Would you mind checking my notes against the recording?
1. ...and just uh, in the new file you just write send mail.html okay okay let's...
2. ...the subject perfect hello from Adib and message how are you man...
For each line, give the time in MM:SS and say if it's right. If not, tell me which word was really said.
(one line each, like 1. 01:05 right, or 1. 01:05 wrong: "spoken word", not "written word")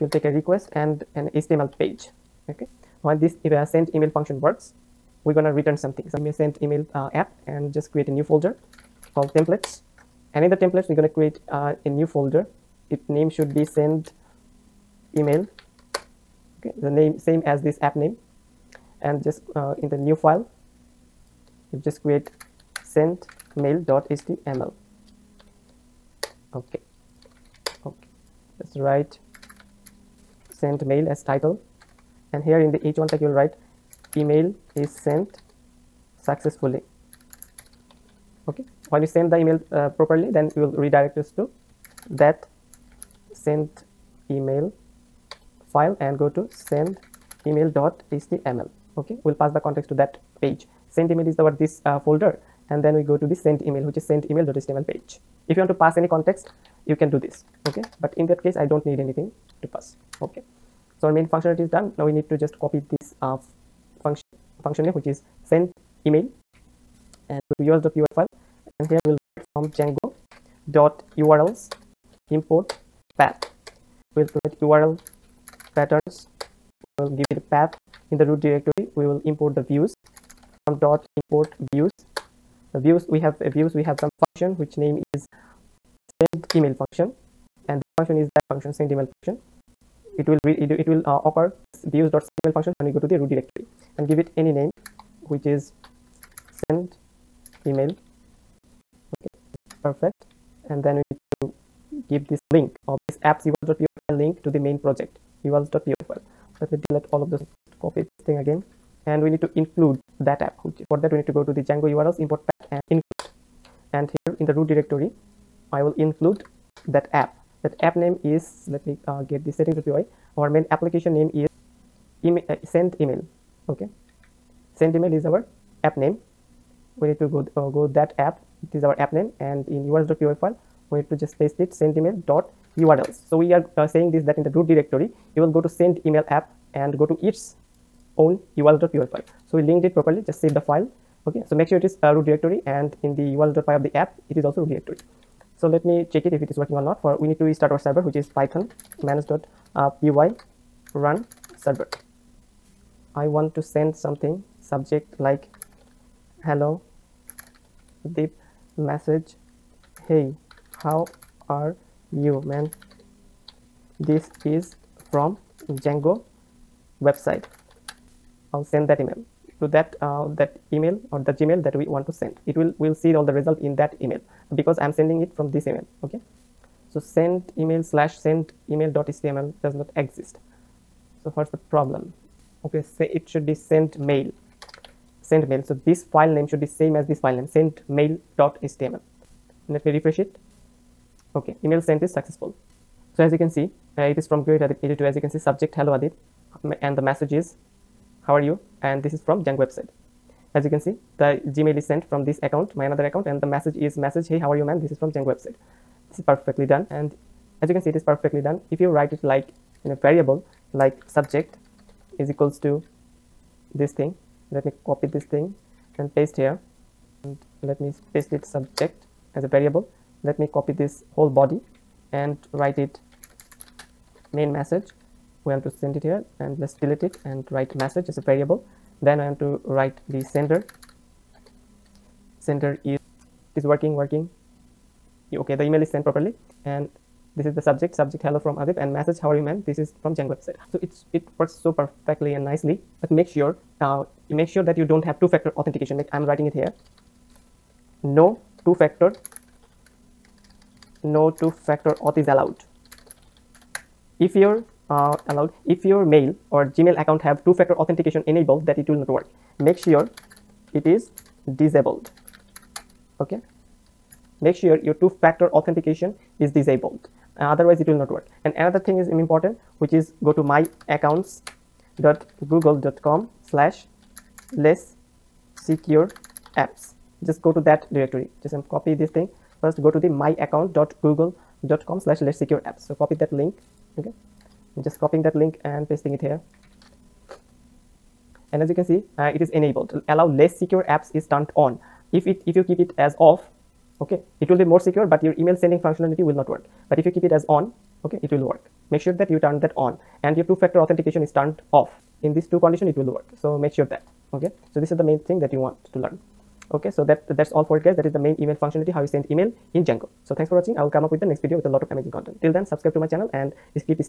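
1. 00:19 wrong: "create", not "write"
2. 03:57 wrong: "subject", not "perfect".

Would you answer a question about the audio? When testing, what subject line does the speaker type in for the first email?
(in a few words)
hello deep.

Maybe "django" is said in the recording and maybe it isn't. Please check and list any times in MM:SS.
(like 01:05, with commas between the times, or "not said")
01:09, 01:51, 02:45, 03:19, 03:25, 04:00, 05:09.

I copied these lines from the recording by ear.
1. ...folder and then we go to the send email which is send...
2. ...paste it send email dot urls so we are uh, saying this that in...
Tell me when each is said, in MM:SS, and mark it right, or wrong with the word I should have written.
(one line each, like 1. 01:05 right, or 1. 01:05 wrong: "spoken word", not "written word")
1. 00:51 right
2. 02:11 right.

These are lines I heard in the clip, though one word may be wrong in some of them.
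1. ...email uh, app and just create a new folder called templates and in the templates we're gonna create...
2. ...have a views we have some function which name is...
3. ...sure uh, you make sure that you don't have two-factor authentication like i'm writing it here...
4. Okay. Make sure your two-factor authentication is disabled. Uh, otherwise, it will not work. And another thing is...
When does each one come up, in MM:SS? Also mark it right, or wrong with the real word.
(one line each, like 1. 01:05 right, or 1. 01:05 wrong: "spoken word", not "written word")
1. 00:06 right
2. 01:23 right
3. 04:03 right
4. 04:23 right.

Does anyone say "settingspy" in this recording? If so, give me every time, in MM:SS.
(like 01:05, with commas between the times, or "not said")
01:59.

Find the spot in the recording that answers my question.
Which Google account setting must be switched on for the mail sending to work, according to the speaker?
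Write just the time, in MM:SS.
04:50.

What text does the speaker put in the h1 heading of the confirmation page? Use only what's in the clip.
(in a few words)
email is sent successfully.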